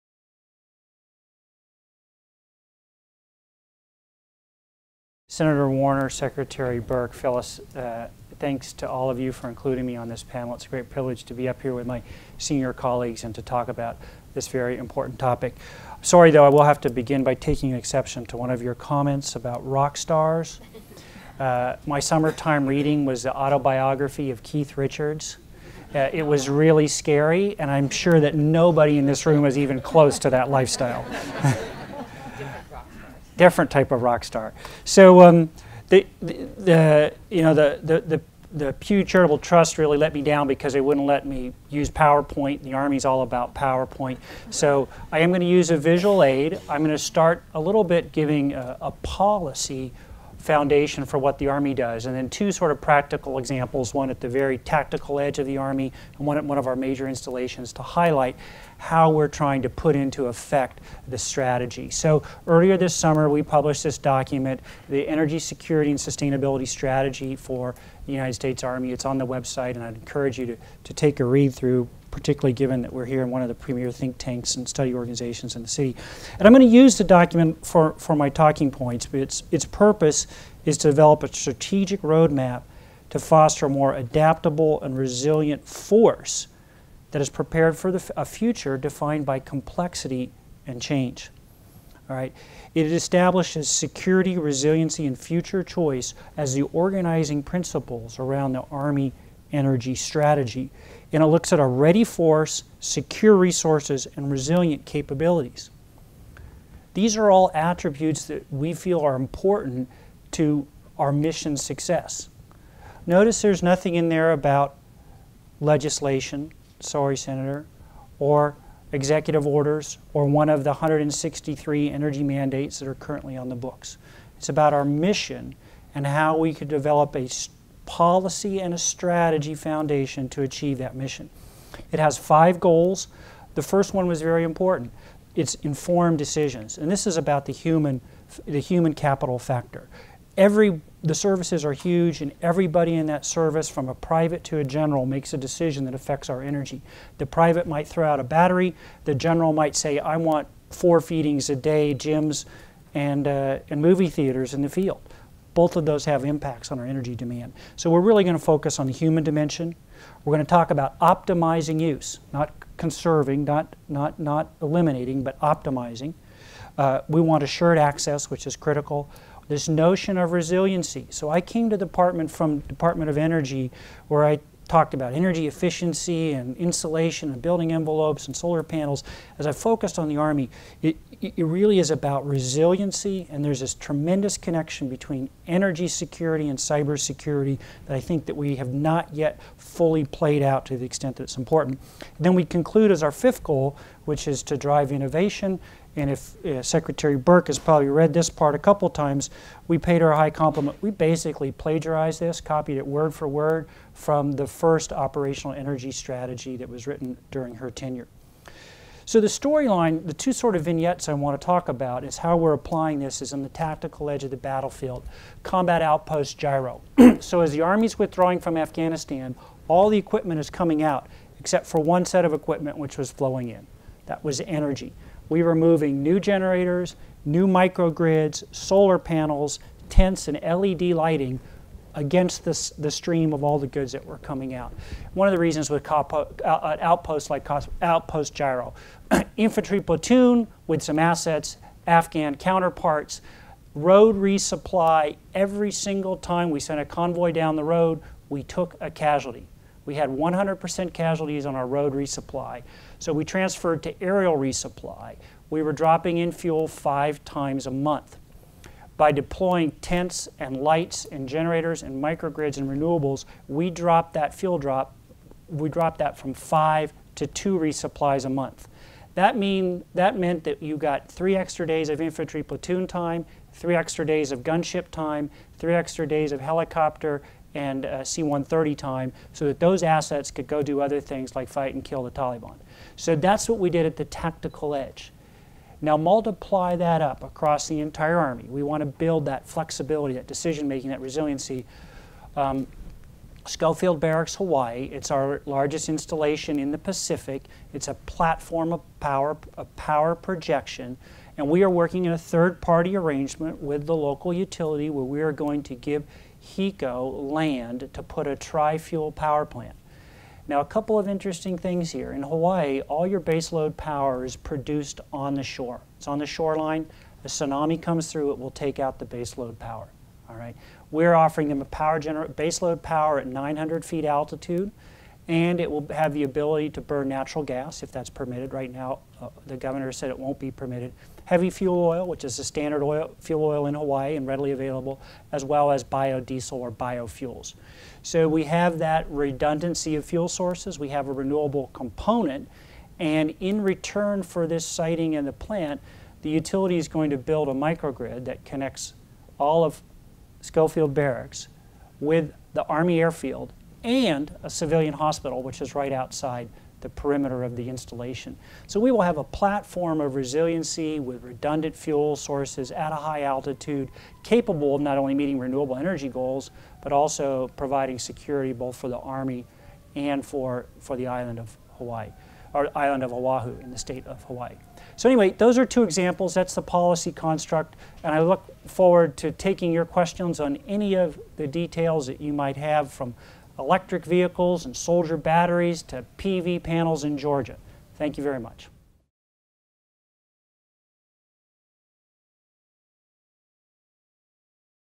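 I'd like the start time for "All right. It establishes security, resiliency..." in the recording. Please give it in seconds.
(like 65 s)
92 s.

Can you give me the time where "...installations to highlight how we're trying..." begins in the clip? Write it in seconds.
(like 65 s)
57 s.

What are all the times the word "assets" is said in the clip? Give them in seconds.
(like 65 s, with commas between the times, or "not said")
240 s, 279 s.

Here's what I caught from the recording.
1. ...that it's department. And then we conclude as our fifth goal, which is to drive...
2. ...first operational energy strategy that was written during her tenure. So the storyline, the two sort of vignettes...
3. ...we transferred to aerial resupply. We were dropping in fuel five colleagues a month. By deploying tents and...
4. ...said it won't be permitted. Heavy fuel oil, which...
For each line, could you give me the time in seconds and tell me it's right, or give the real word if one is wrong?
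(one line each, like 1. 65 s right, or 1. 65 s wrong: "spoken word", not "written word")
1. 191 s wrong: "important", not "department"
2. 204 s right
3. 253 s wrong: "times", not "colleagues"
4. 329 s right.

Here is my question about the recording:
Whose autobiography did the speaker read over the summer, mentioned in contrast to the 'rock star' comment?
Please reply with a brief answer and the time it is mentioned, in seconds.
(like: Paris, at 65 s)
Keith Richards, at 24 s.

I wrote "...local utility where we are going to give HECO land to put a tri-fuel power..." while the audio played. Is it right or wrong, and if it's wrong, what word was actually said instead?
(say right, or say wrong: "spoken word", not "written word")
right.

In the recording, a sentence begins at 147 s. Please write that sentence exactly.
The private might throw out a battery.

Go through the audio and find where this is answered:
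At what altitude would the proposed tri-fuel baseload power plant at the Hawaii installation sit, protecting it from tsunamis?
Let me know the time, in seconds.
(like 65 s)
323 s.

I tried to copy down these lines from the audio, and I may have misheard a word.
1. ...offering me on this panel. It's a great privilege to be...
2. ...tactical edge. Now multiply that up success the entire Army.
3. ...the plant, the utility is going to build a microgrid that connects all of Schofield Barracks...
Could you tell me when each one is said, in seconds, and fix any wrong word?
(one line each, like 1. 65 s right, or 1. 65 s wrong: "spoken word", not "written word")
1. 9 s wrong: "including", not "offering"
2. 284 s wrong: "across", not "success"
3. 345 s right.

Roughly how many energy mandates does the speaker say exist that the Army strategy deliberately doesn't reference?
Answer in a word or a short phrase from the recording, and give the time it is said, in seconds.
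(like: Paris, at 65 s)
163, at 120 s.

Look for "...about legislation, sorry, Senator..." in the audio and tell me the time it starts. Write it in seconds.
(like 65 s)
114 s.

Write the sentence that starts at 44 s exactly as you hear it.
So I am going to use a visual aid.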